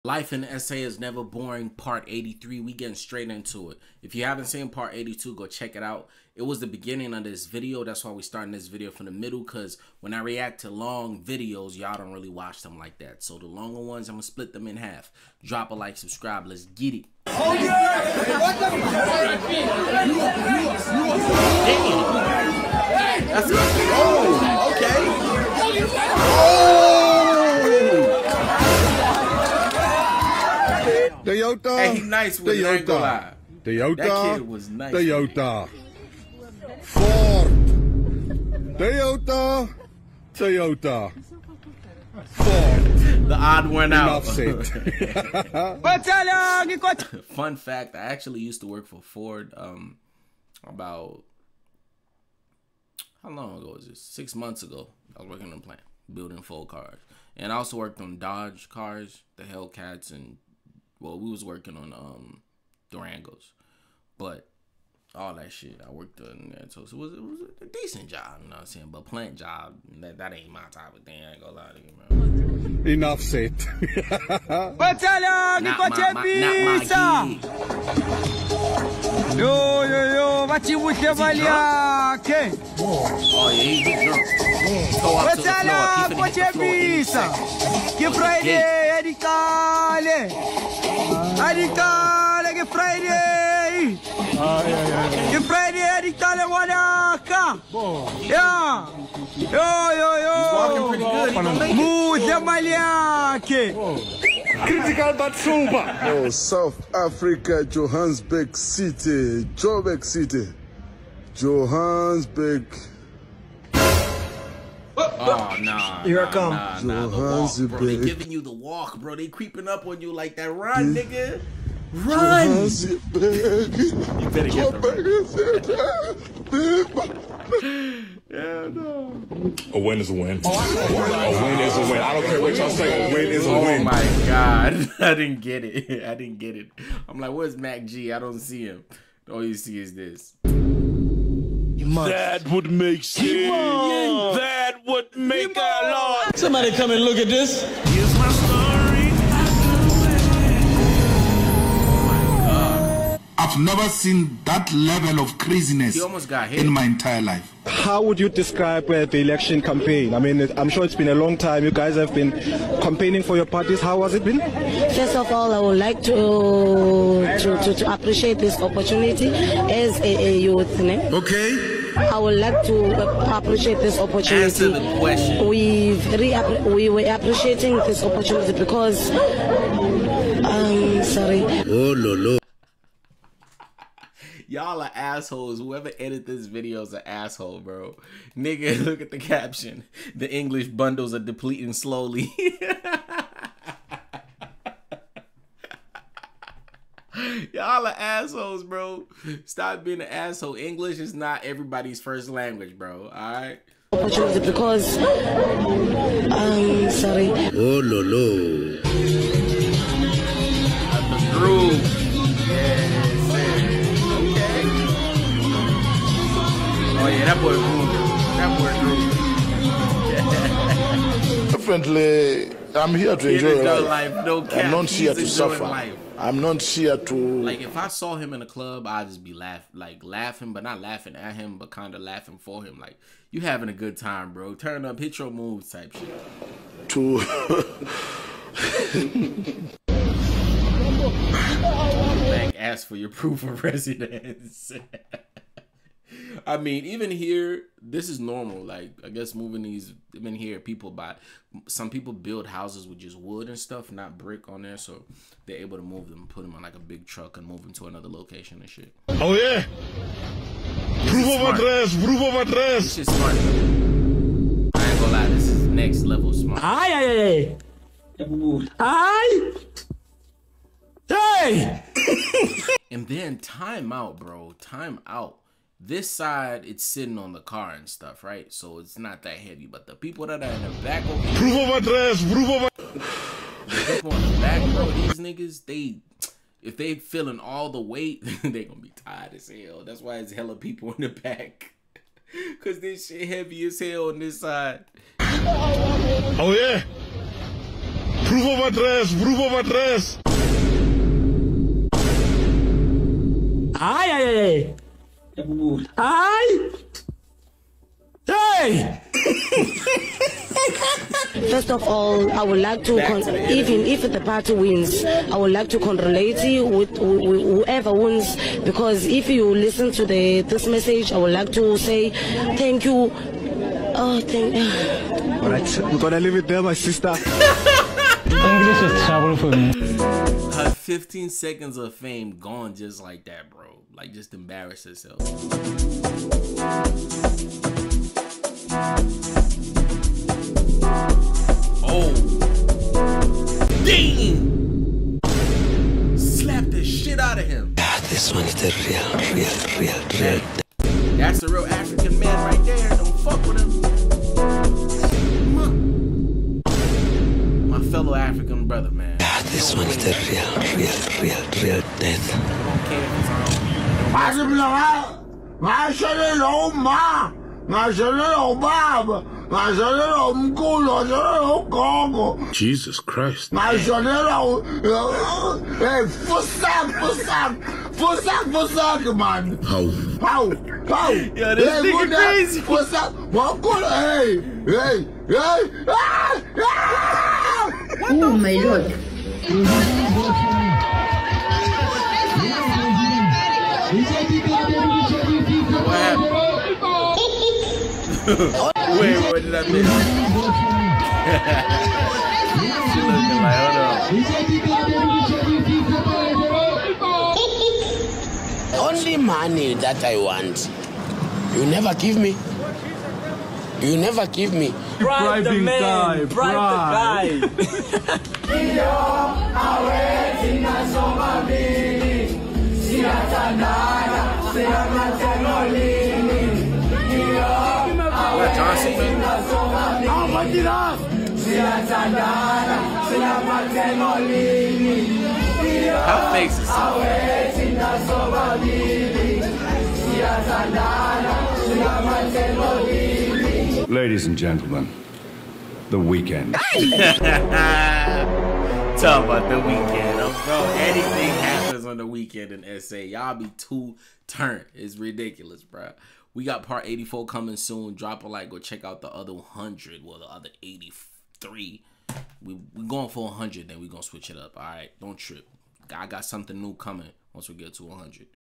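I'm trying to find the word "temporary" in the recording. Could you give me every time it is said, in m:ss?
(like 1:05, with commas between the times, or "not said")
not said.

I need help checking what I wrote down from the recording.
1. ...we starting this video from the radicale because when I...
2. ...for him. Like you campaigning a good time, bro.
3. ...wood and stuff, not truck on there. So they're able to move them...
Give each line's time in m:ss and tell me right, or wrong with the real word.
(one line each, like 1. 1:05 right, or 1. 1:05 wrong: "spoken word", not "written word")
1. 0:08 wrong: "middle", not "radicale"
2. 3:52 wrong: "having", not "campaigning"
3. 4:13 wrong: "brick", not "truck".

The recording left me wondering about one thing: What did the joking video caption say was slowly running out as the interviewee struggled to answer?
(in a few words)
English bundles.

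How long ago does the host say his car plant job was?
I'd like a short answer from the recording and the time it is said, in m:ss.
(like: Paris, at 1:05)
Six months ago, at 0:54.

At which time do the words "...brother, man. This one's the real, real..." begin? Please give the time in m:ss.
5:58.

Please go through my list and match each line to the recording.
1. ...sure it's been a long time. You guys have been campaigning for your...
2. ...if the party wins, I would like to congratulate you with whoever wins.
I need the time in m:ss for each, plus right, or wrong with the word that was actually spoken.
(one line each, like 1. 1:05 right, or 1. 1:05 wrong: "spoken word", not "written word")
1. 2:40 right
2. 5:13 right.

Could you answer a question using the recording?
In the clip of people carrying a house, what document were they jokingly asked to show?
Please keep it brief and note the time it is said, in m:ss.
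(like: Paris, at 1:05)
Proof of residence, at 4:03.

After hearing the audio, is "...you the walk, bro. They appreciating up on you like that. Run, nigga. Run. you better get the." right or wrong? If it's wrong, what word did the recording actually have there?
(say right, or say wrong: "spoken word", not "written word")
wrong: "creeping", not "appreciating".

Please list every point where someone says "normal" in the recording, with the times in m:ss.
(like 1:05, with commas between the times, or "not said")
4:08.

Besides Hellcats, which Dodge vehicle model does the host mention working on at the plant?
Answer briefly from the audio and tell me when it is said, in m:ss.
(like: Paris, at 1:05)
Durangos, at 1:02.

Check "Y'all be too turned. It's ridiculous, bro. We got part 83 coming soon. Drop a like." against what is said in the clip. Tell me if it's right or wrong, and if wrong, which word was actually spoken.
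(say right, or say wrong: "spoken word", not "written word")
wrong: "84", not "83".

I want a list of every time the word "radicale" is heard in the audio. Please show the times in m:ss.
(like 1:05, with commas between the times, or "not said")
1:31, 1:35.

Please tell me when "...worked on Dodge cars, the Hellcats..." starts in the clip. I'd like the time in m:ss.
0:57.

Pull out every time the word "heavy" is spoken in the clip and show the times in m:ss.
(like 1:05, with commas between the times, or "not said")
4:39, 4:53.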